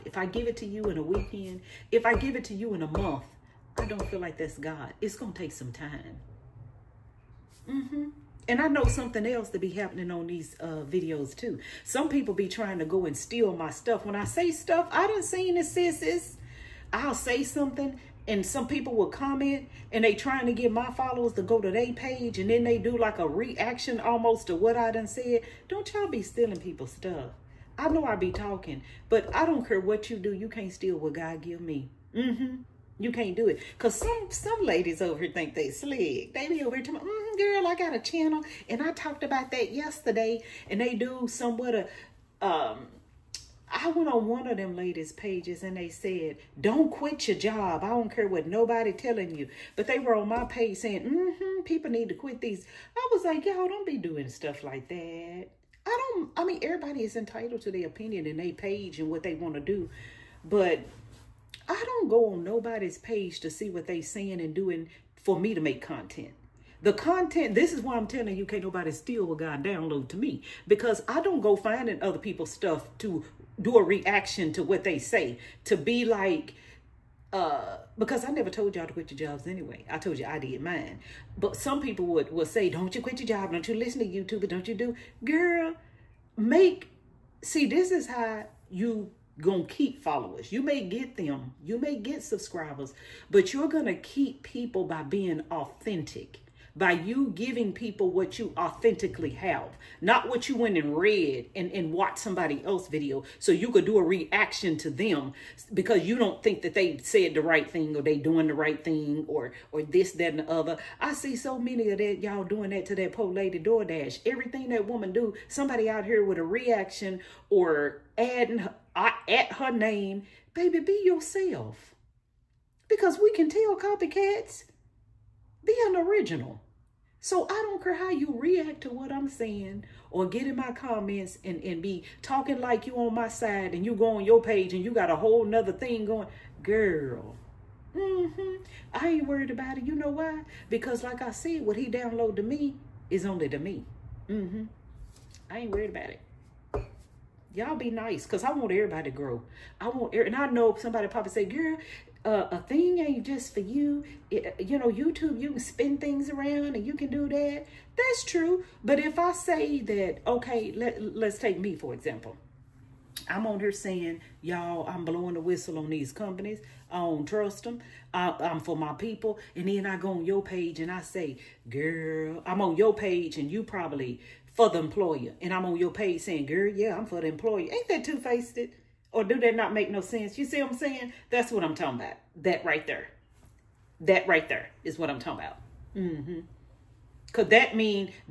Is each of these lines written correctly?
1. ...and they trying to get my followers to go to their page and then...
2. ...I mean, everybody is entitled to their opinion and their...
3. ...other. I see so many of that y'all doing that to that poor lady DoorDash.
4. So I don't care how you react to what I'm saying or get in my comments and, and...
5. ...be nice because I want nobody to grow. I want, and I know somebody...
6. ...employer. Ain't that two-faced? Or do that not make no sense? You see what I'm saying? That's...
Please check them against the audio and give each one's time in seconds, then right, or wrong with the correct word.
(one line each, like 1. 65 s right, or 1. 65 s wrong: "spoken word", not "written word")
1. 19 s right
2. 56 s right
3. 110 s right
4. 127 s right
5. 147 s wrong: "everybody", not "nobody"
6. 177 s right.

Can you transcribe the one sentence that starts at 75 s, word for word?
To be like, uh, because I never told y'all to quit your jobs anyway.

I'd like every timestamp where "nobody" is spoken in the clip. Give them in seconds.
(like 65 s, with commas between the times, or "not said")
48 s, 62 s, 68 s.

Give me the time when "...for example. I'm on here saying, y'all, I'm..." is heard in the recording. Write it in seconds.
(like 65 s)
161 s.